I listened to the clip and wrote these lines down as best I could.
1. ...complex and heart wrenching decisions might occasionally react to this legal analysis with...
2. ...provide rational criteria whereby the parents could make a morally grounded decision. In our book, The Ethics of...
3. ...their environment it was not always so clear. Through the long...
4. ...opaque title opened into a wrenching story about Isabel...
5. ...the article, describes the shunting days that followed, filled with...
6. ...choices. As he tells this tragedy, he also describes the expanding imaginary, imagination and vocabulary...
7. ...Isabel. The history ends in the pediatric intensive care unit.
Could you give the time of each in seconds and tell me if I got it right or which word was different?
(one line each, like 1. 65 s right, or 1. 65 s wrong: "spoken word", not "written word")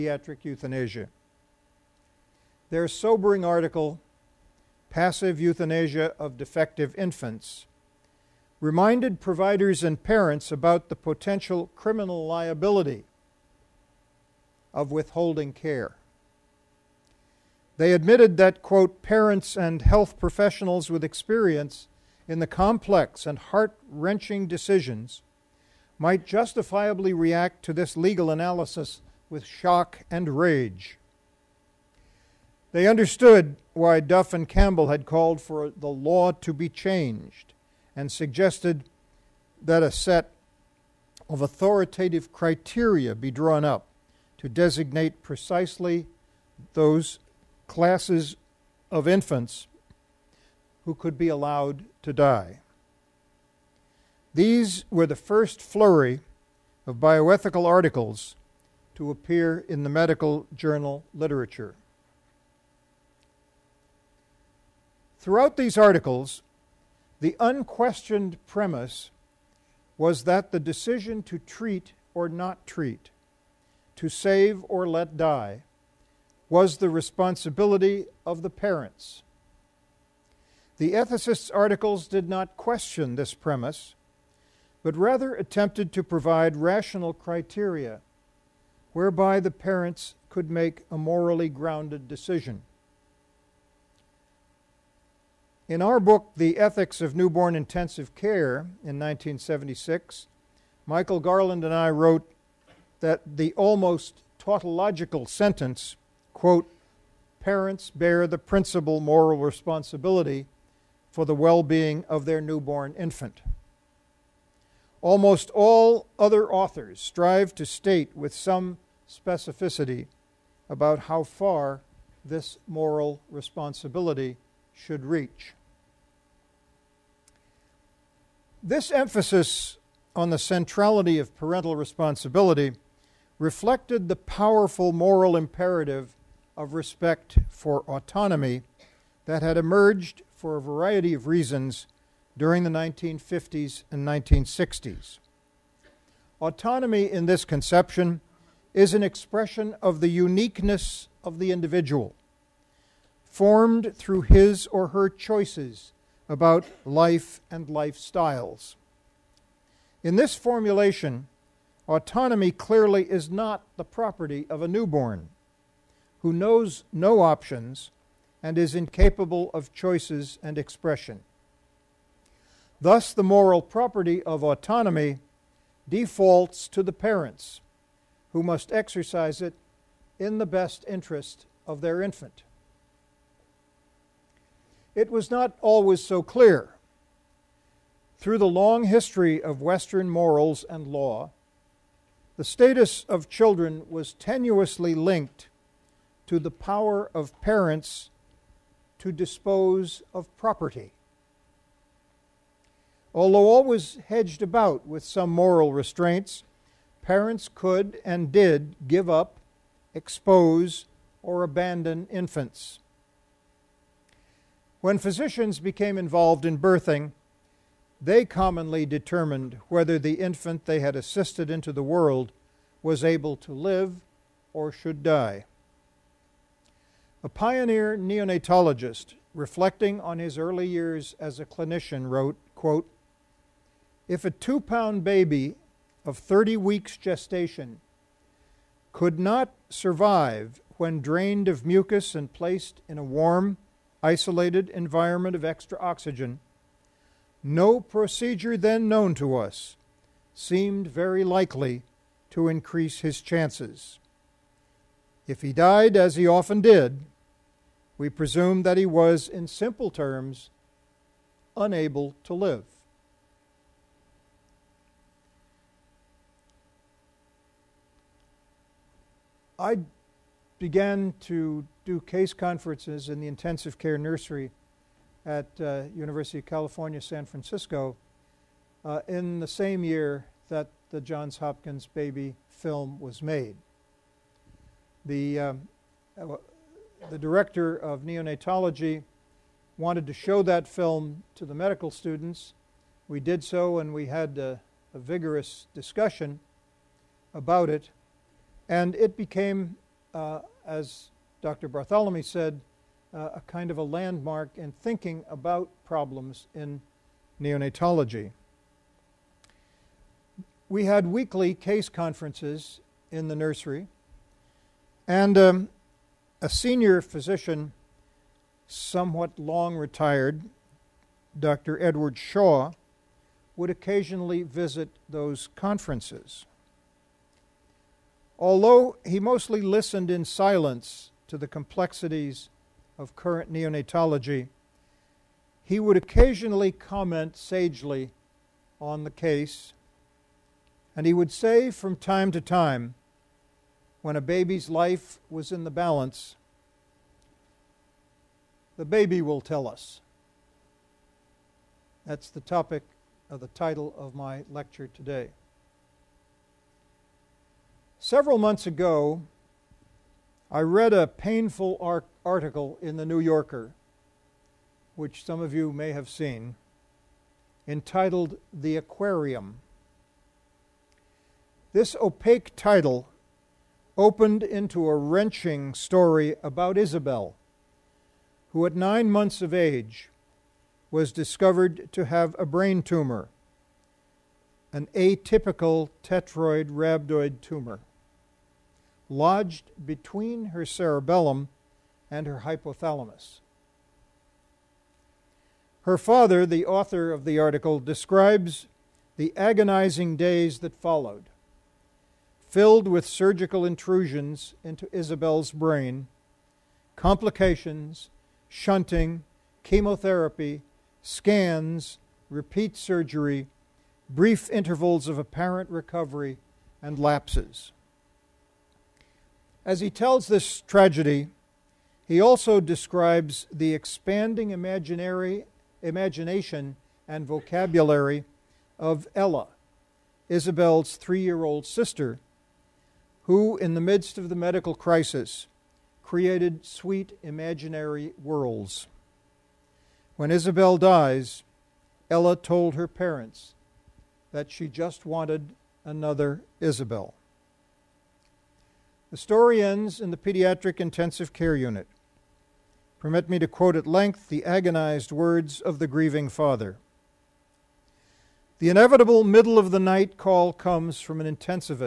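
1. 22 s wrong: "justifiably", not "occasionally"
2. 86 s right
3. 181 s wrong: "infant", not "environment"
4. 372 s right
5. 397 s wrong: "agonizing", not "shunting"
6. 416 s wrong: "lapses", not "choices"
7. 446 s wrong: "story", not "history".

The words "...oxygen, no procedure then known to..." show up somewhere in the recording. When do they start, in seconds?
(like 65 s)
245 s.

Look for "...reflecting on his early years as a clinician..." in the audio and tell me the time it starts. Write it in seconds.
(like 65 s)
229 s.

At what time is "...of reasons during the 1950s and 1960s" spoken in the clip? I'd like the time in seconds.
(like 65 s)
141 s.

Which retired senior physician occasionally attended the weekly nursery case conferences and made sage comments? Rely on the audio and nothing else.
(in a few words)
Edward Shaw.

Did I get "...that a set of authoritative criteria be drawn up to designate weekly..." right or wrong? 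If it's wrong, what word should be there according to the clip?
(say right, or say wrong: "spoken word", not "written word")
wrong: "precisely", not "weekly".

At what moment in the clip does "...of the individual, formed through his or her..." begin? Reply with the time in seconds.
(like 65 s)
151 s.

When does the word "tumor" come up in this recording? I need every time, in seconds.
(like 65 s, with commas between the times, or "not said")
382 s, 387 s.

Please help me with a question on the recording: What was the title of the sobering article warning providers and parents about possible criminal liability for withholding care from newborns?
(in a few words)
Passive Euthanasia of Defective Infants.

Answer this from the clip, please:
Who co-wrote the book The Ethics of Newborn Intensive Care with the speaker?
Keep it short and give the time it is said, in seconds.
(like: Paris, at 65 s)
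Michael Garland, at 100 s.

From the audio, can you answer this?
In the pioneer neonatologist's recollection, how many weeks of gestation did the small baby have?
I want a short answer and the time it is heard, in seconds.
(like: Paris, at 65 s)
30 weeks, at 236 s.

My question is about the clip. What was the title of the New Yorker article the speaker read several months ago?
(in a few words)
The Aquarium.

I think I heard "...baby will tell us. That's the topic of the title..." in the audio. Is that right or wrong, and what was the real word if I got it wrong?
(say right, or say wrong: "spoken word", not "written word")
right.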